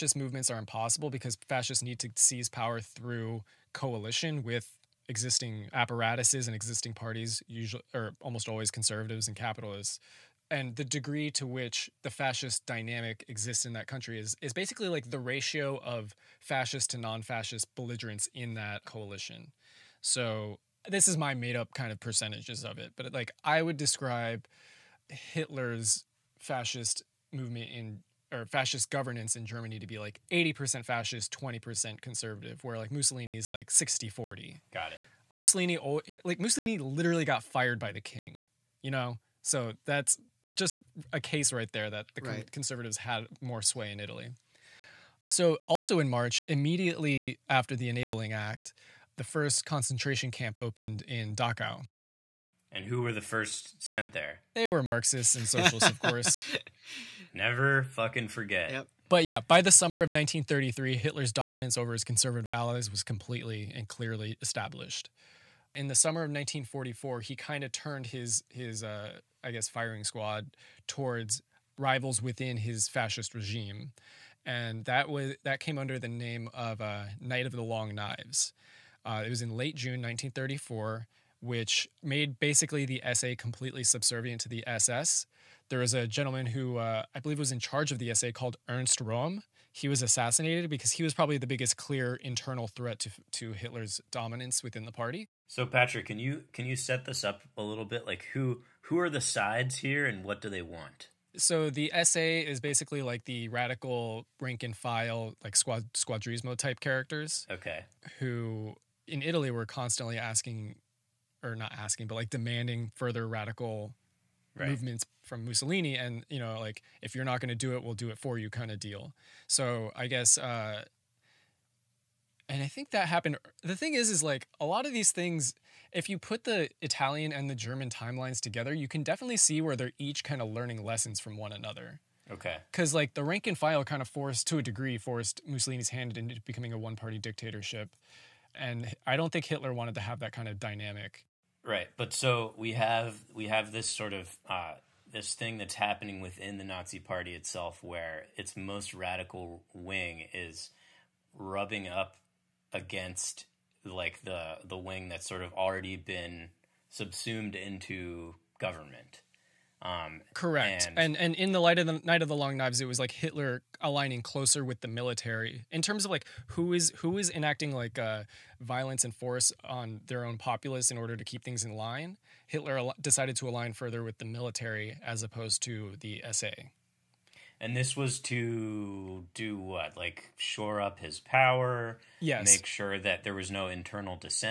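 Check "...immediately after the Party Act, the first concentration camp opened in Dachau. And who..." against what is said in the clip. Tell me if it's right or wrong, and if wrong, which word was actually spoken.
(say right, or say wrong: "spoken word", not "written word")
wrong: "Enabling", not "Party".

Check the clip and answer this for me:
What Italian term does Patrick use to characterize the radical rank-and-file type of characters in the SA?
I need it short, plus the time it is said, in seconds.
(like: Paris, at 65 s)
squadrismo, at 105 s.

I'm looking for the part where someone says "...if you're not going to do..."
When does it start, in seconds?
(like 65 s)
117 s.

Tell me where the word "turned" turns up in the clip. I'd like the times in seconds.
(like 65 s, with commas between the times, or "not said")
67 s.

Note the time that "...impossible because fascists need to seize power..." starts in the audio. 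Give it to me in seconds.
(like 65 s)
0 s.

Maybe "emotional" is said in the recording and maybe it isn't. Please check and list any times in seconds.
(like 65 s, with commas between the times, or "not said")
not said.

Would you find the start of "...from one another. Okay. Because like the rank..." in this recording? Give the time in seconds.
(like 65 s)
131 s.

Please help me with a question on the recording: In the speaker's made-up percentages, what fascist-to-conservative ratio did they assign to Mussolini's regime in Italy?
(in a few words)
60/40.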